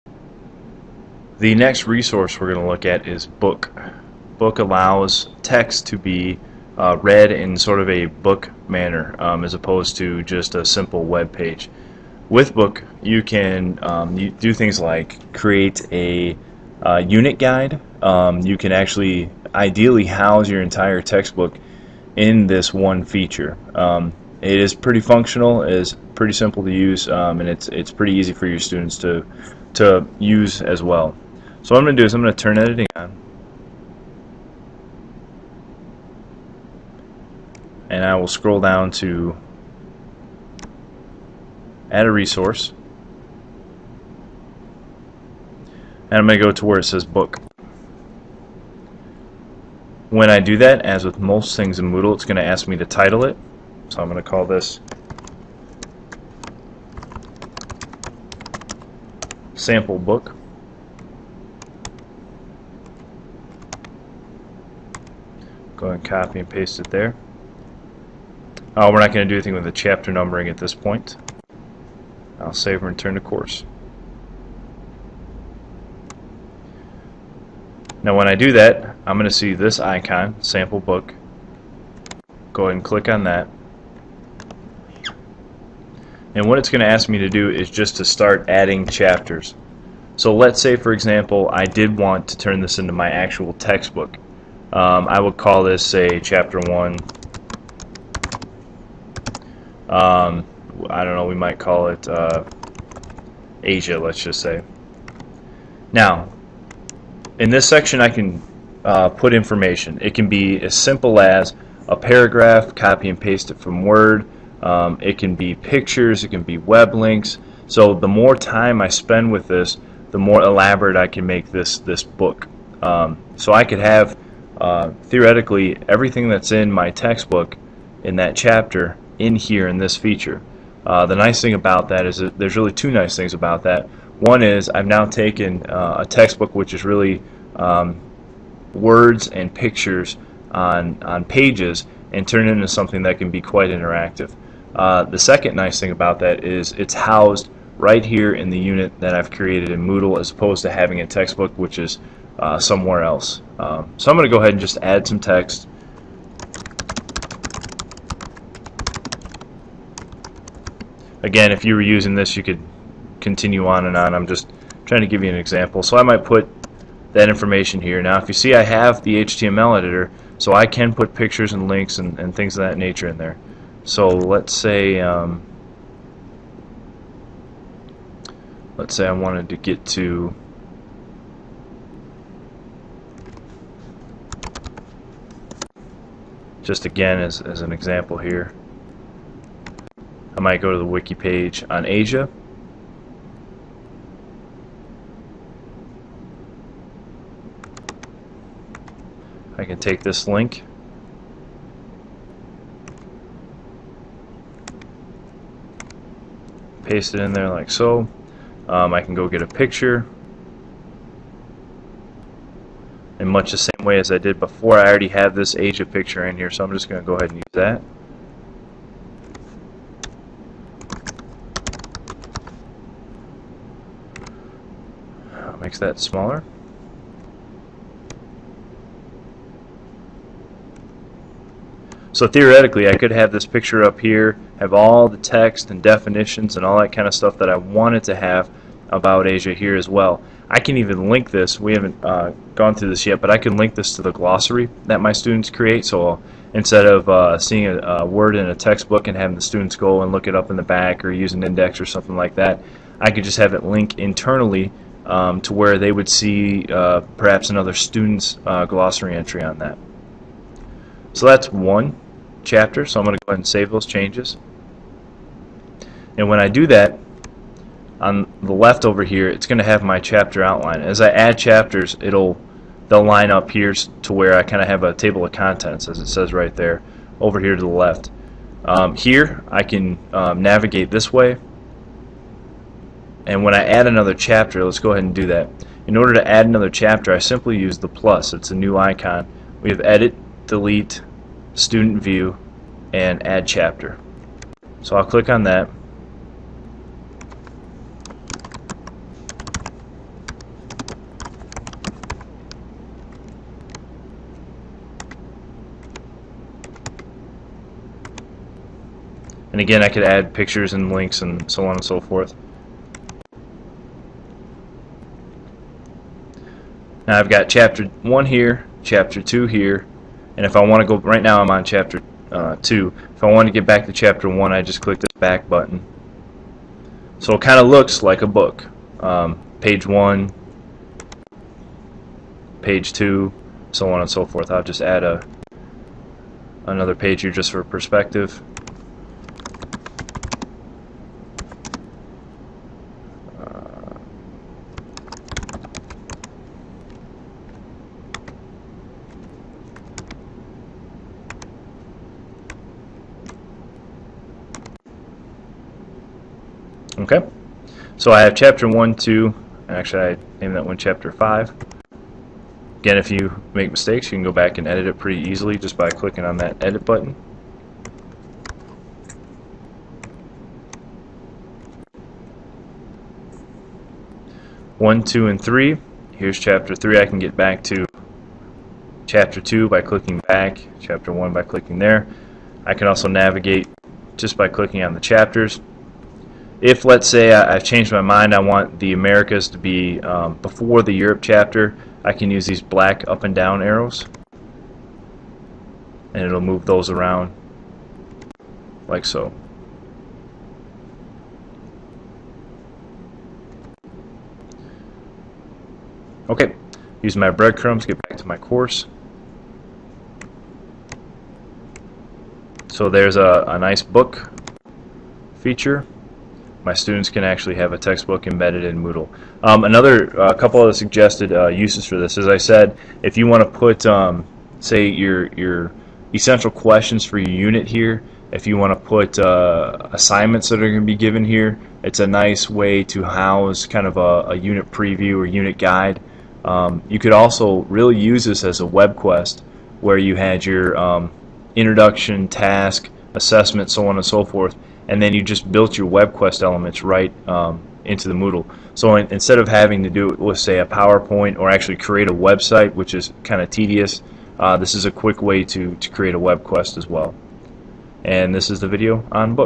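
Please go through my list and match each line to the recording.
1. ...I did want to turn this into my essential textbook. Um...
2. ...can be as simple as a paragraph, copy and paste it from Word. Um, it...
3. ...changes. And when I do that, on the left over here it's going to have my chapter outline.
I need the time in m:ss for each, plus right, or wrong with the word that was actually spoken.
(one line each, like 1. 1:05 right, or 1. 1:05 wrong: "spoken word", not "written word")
1. 1:31 wrong: "actual", not "essential"
2. 1:50 right
3. 4:23 right.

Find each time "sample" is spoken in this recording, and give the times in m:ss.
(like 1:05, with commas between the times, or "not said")
0:59, 1:20.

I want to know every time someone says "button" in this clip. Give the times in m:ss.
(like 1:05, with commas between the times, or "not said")
5:25, 6:06.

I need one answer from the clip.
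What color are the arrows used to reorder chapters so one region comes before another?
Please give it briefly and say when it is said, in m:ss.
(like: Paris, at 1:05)
black, at 6:32.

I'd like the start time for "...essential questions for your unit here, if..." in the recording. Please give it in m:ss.
7:06.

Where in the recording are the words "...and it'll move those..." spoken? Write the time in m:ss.
6:36.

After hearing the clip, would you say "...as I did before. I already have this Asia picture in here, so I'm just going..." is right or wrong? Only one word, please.
right.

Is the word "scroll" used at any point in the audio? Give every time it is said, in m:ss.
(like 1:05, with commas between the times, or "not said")
0:38.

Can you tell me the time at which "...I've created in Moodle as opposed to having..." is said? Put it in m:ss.
2:29.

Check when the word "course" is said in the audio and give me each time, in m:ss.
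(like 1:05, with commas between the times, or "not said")
1:13, 6:48.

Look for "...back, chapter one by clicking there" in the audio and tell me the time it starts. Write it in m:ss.
6:20.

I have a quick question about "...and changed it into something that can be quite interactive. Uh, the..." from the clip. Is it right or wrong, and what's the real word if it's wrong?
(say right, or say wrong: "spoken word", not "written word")
wrong: "turned", not "changed".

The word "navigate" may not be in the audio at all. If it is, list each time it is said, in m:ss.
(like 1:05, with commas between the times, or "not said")
4:40, 6:23.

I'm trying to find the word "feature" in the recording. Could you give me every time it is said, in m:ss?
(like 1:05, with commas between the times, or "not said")
0:23, 2:09, 6:55.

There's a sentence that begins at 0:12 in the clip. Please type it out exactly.
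With Book, you can um, you do things like create a uh, unit guide.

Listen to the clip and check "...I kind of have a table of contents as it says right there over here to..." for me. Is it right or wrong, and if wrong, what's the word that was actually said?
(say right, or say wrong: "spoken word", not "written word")
right.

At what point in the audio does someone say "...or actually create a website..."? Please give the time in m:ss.
7:31.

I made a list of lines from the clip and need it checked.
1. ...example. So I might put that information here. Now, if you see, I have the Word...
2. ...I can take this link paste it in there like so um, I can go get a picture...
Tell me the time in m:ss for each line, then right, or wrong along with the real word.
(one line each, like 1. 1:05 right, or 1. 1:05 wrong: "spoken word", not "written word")
1. 2:45 wrong: "HTML", not "Word"
2. 3:19 right.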